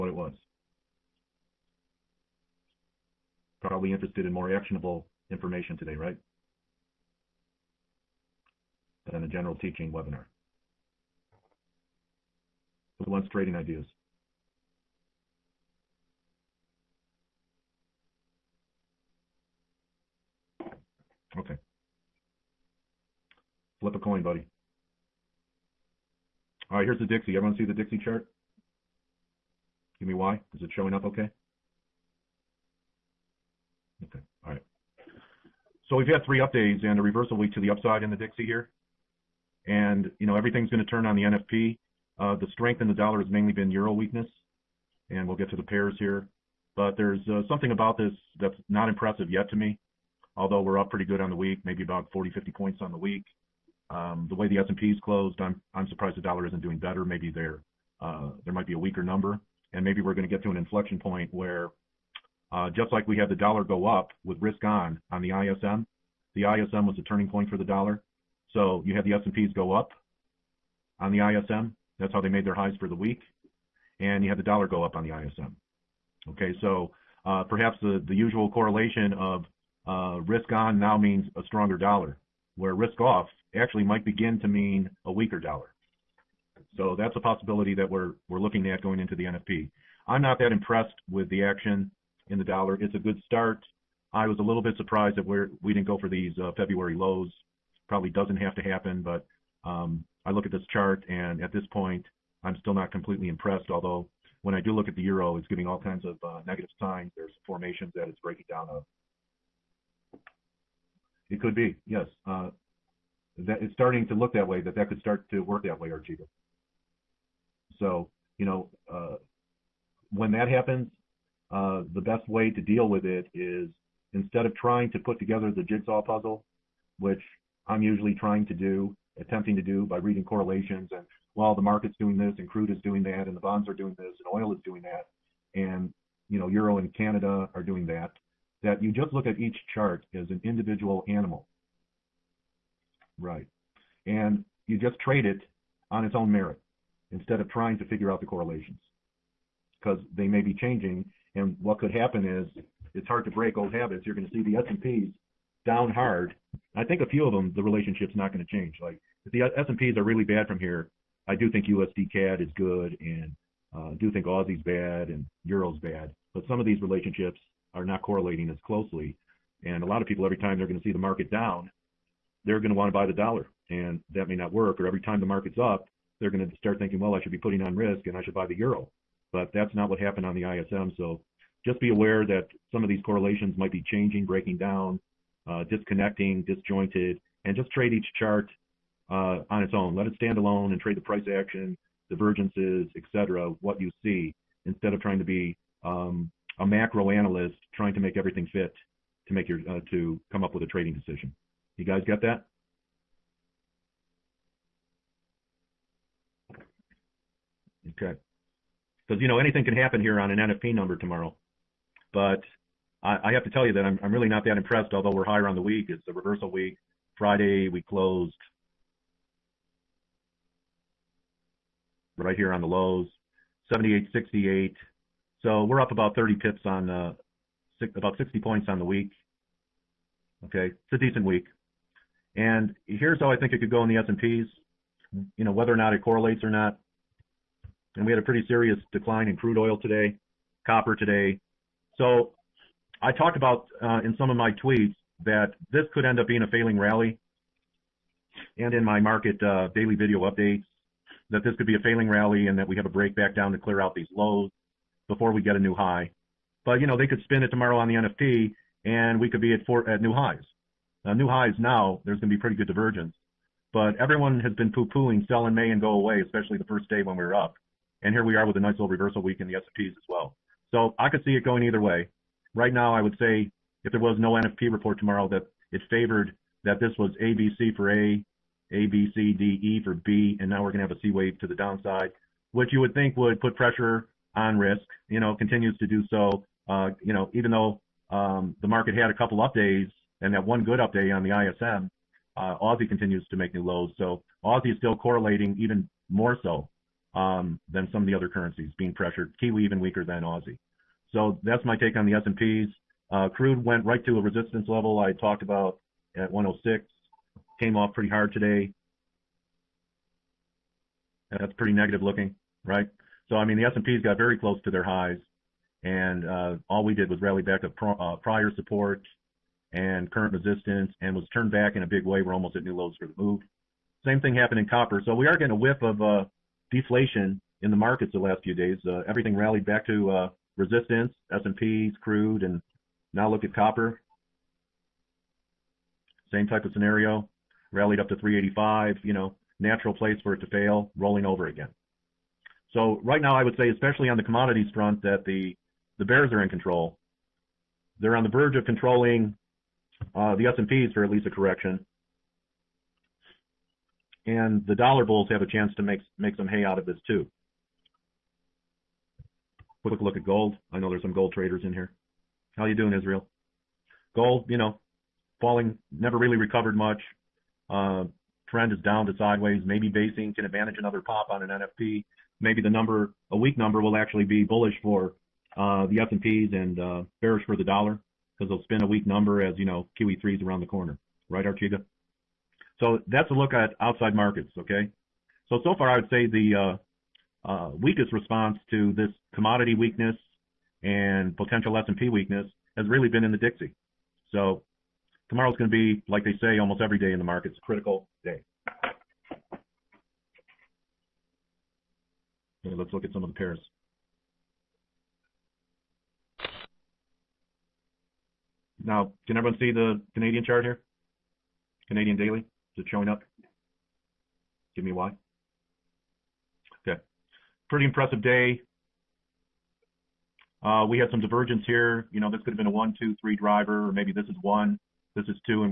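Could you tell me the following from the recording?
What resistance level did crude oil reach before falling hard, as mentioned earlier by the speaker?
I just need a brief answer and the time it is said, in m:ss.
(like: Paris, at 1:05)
106, at 5:06.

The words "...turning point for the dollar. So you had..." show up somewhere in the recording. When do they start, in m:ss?
1:07.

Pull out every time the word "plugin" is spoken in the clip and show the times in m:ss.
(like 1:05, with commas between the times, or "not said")
not said.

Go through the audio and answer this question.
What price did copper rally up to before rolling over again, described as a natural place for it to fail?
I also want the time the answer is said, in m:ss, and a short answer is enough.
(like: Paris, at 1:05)
385, at 5:38.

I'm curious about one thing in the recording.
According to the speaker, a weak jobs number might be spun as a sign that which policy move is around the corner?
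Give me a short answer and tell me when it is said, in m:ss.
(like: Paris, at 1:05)
QE3, at 6:19.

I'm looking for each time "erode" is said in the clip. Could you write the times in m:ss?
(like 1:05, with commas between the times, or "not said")
not said.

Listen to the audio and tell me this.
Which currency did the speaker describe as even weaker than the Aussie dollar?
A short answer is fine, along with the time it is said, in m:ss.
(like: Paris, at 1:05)
Kiwi, at 4:59.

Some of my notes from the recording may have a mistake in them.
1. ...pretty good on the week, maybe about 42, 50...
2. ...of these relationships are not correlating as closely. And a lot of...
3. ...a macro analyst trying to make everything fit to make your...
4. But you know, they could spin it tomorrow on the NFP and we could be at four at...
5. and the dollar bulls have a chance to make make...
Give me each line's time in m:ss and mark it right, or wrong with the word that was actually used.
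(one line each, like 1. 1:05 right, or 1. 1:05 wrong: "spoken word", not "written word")
1. 0:50 wrong: "40", not "42"
2. 2:46 right
3. 3:16 right
4. 4:16 right
5. 5:54 right.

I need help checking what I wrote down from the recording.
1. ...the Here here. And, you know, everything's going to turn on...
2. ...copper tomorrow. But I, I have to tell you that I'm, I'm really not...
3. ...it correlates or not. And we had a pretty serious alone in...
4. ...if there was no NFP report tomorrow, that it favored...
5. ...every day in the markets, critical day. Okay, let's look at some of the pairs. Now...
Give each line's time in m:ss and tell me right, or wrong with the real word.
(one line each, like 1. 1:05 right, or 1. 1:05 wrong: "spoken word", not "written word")
1. 0:38 wrong: "Dixie", not "Here"
2. 3:30 wrong: "number", not "copper"
3. 3:55 wrong: "decline", not "alone"
4. 4:33 right
5. 6:36 right.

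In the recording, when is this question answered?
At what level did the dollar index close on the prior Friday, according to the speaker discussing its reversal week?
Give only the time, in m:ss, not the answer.
3:43.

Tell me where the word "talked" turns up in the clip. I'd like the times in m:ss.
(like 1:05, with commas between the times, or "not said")
4:03, 5:05.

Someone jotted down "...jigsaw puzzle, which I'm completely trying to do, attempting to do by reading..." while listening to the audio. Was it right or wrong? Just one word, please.
wrong.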